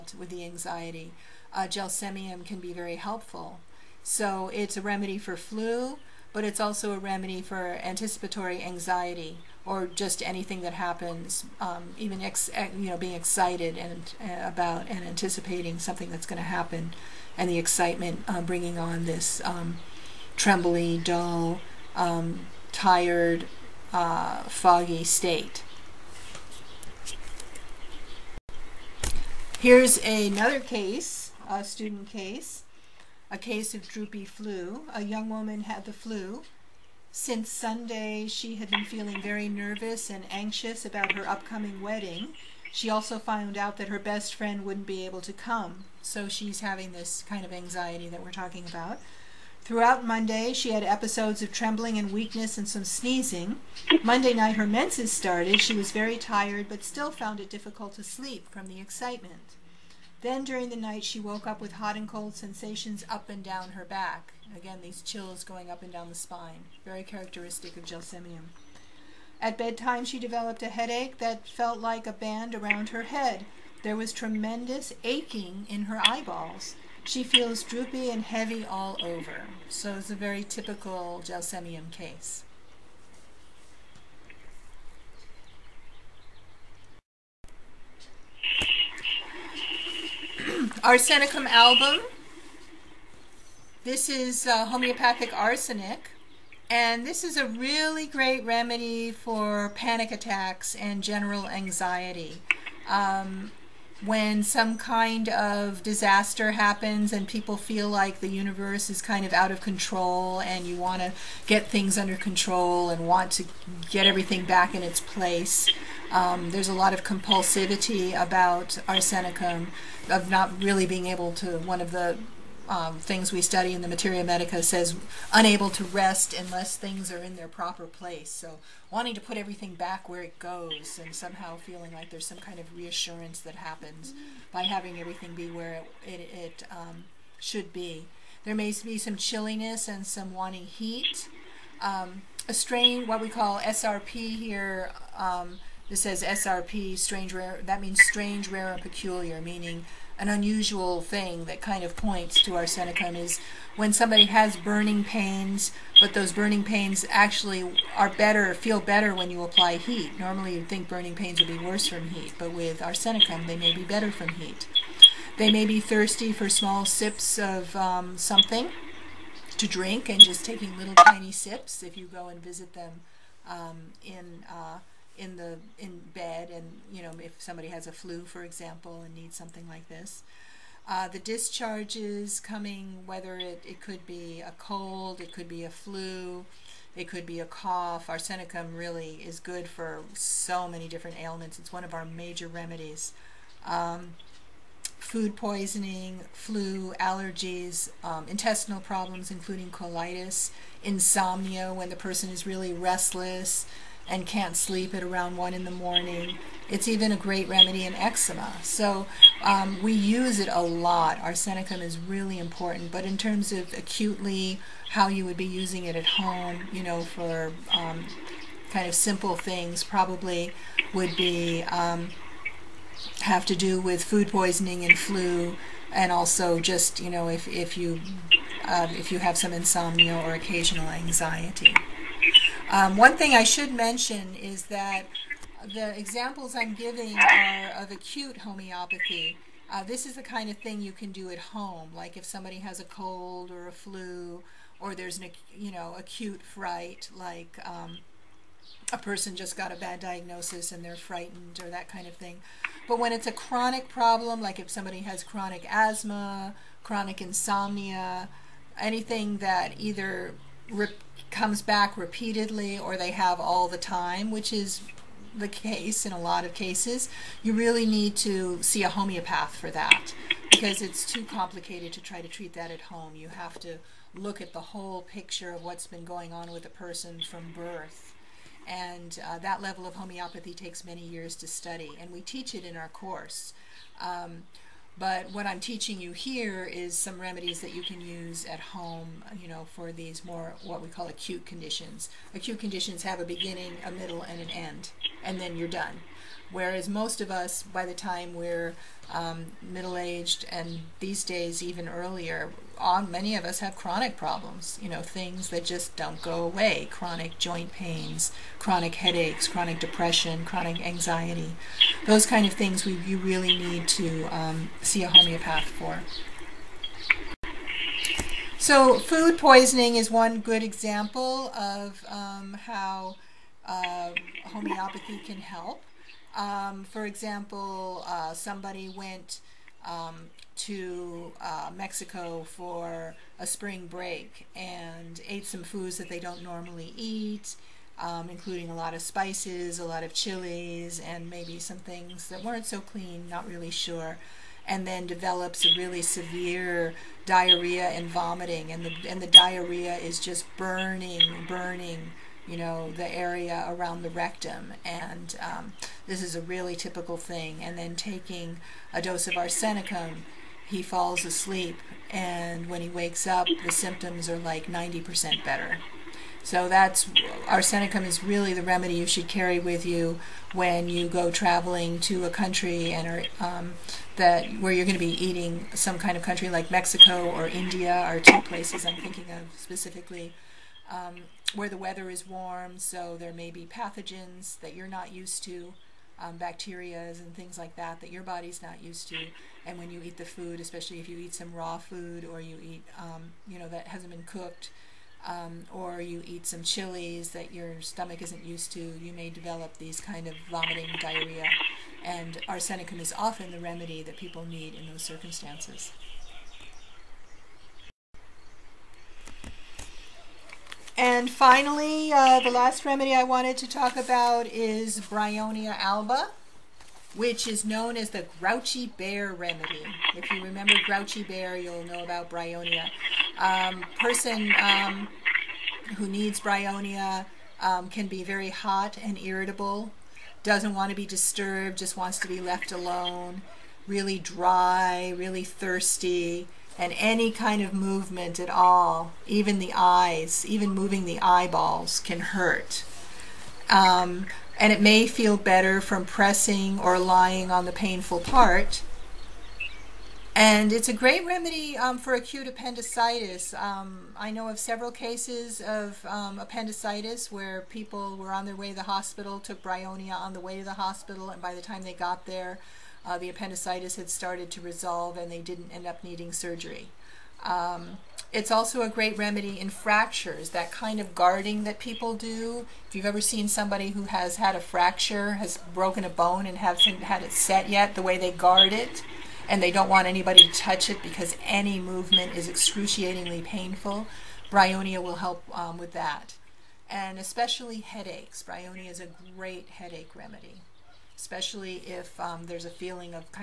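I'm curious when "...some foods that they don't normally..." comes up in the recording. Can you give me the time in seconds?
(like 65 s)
335 s.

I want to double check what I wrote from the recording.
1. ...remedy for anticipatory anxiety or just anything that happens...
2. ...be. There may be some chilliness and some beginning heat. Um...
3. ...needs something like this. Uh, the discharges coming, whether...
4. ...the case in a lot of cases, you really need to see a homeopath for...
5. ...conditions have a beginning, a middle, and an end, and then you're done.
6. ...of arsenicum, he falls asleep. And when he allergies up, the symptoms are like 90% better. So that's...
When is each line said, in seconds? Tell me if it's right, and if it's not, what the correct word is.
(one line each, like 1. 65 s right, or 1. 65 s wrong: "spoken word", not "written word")
1. 6 s right
2. 137 s wrong: "wanting", not "beginning"
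3. 179 s right
4. 265 s right
5. 292 s right
6. 359 s wrong: "wakes", not "allergies".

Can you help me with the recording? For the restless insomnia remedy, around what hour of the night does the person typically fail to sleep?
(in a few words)
1 in the morning.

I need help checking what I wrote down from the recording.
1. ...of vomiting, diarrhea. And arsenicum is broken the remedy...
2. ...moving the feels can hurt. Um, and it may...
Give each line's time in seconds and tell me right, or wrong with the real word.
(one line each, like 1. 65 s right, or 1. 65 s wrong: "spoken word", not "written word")
1. 400 s wrong: "often", not "broken"
2. 440 s wrong: "eyeballs", not "feels".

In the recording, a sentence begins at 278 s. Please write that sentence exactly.
And uh, that level of homeopathy takes many years to study, and we teach it in our course.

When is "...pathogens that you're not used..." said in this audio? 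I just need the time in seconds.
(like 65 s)
383 s.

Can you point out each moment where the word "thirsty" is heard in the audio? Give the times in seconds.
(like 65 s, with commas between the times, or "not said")
165 s, 435 s.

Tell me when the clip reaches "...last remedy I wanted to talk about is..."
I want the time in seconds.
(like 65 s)
412 s.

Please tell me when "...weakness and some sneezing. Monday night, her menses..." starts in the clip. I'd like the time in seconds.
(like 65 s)
52 s.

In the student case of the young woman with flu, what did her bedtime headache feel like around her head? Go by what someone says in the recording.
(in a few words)
A band.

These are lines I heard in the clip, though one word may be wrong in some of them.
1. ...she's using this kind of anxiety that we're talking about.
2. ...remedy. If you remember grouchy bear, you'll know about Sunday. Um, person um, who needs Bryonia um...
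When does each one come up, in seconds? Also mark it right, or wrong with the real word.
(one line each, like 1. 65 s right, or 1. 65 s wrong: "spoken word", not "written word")
1. 46 s wrong: "having", not "using"
2. 419 s wrong: "Bryonia", not "Sunday".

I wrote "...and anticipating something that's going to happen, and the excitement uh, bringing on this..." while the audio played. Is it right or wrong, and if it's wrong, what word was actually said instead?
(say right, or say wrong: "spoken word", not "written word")
right.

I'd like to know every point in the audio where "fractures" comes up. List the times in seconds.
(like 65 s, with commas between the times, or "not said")
469 s, 474 s.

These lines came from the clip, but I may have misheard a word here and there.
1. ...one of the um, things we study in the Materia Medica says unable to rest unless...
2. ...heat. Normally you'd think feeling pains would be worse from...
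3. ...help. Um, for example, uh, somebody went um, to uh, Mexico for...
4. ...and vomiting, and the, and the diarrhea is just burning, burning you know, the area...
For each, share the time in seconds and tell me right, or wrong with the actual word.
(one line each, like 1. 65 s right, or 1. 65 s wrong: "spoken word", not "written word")
1. 121 s right
2. 159 s wrong: "burning", not "feeling"
3. 325 s right
4. 347 s right.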